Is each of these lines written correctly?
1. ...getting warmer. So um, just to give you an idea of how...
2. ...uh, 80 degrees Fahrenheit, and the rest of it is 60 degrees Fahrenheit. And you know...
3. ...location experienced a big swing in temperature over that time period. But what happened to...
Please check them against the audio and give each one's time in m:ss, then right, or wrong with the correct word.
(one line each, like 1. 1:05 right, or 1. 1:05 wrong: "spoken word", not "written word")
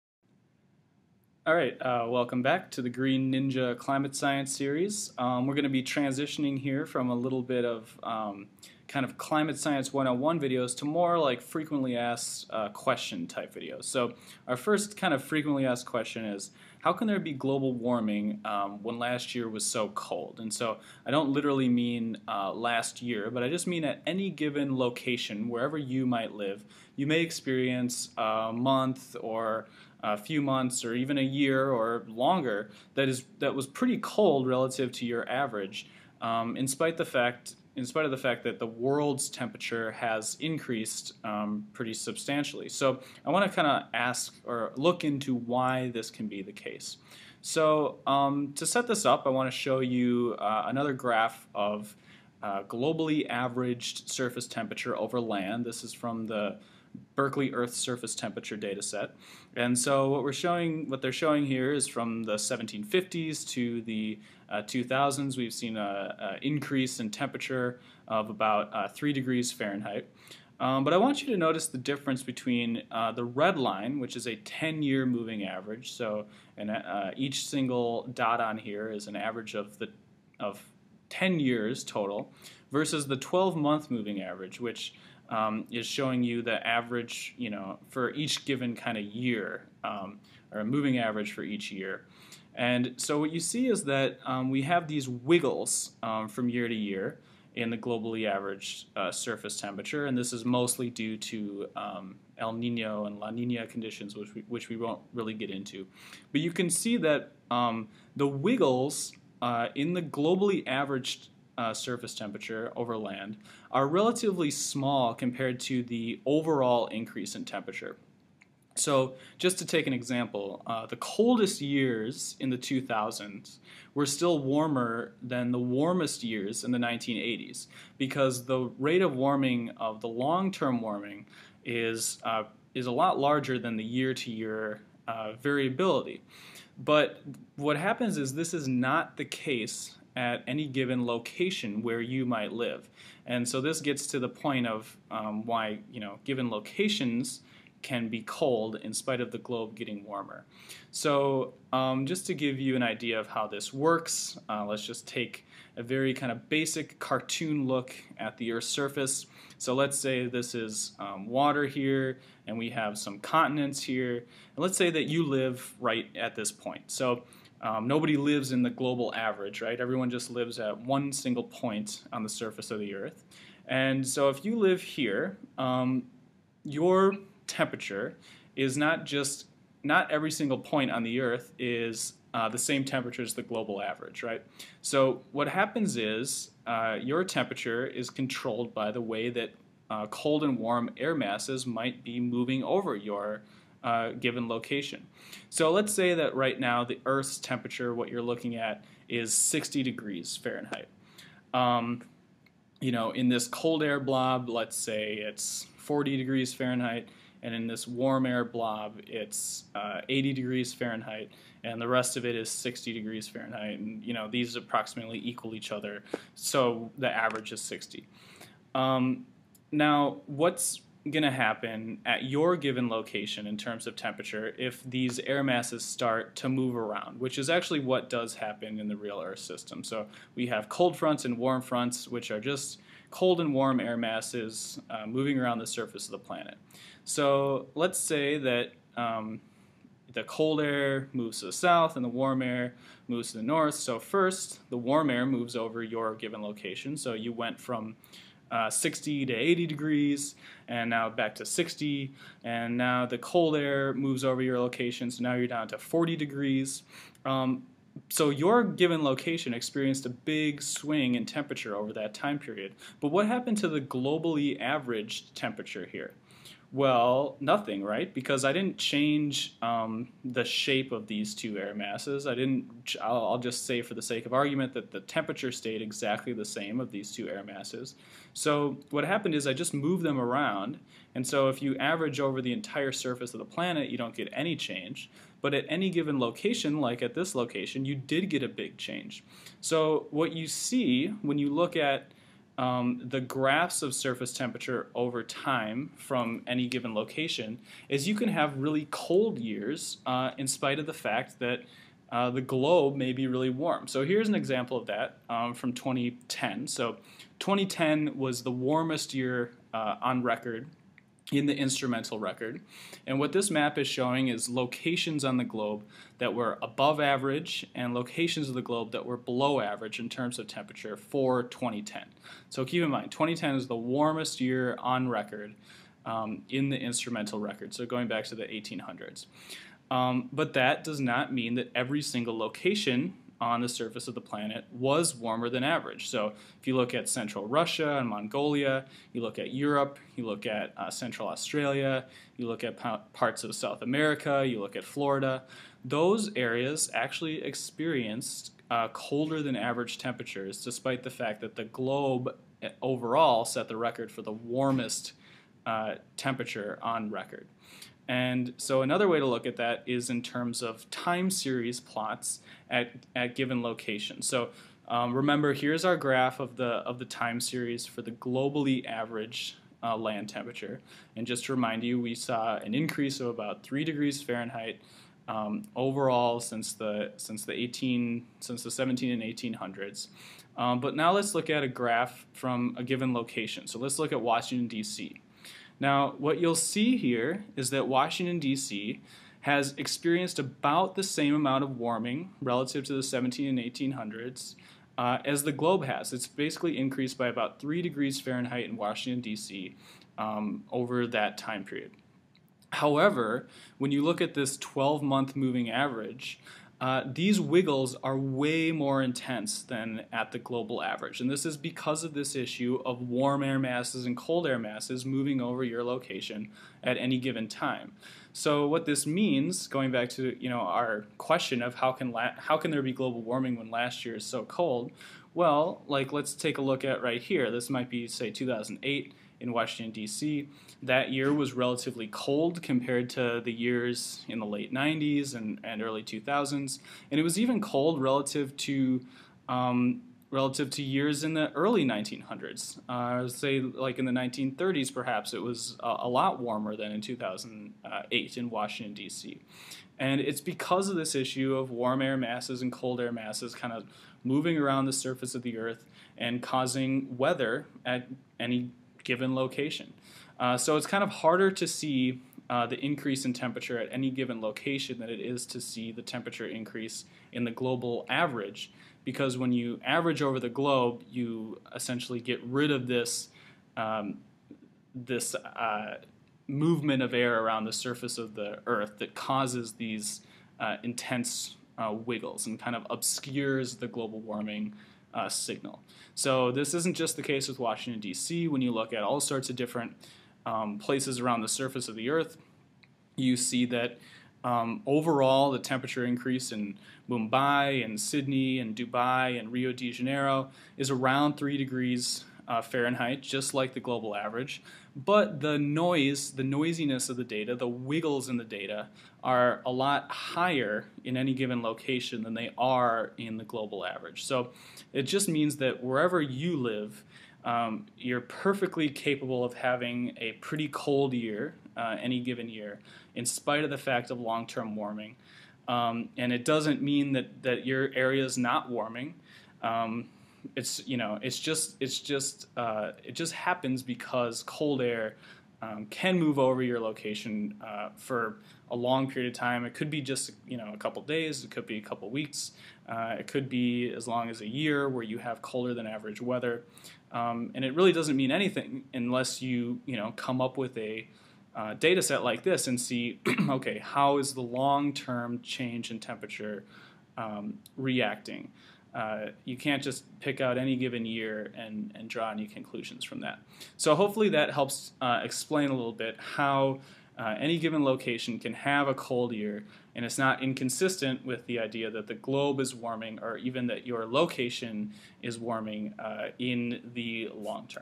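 1. 2:29 right
2. 3:29 right
3. 4:19 right.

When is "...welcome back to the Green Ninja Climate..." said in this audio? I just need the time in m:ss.
0:02.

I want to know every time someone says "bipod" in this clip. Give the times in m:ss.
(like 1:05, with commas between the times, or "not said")
not said.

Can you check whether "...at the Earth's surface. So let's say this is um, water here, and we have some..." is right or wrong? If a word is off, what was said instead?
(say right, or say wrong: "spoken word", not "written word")
right.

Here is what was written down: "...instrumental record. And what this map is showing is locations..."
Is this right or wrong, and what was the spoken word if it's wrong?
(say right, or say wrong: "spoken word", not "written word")
right.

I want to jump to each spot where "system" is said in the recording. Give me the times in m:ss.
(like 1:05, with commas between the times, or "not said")
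3:49.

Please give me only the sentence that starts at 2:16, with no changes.
But what happens is this is not the case at any given location where you might live.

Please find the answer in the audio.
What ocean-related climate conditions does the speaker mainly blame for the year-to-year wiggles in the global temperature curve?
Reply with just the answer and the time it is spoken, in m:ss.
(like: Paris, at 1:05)
El Nino and La Nina, at 1:42.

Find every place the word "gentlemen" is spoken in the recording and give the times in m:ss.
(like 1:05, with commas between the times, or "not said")
not said.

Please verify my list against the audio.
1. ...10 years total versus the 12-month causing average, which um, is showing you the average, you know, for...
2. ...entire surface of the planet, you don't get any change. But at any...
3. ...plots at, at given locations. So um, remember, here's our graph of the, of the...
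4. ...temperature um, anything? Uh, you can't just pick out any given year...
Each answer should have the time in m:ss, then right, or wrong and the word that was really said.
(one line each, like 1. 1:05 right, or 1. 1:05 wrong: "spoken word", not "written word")
1. 1:21 wrong: "moving", not "causing"
2. 4:42 right
3. 6:01 right
4. 9:15 wrong: "reacting", not "anything".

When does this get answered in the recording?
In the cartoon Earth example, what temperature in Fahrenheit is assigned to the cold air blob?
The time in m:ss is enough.
3:25.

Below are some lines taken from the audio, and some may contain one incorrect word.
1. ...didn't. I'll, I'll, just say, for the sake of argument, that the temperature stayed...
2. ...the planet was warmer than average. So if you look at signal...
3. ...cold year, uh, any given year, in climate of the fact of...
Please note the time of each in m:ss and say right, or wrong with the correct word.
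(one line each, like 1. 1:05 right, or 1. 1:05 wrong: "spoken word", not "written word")
1. 4:32 right
2. 5:34 wrong: "central", not "signal"
3. 8:40 wrong: "spite", not "climate".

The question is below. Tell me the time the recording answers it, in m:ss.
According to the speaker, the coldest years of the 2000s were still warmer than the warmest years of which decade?
2:06.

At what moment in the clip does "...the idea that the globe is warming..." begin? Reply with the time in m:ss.
9:31.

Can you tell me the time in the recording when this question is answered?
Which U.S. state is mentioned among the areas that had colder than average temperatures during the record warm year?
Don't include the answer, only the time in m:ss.
5:44.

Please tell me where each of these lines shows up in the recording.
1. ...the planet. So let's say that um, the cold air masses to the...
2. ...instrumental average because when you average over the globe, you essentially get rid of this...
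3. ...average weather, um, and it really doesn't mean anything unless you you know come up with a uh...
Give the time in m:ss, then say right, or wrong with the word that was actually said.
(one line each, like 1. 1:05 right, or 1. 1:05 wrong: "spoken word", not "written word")
1. 3:56 wrong: "moves", not "masses"
2. 7:47 wrong: "global", not "instrumental"
3. 9:05 right.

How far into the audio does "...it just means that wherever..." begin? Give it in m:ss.
8:34.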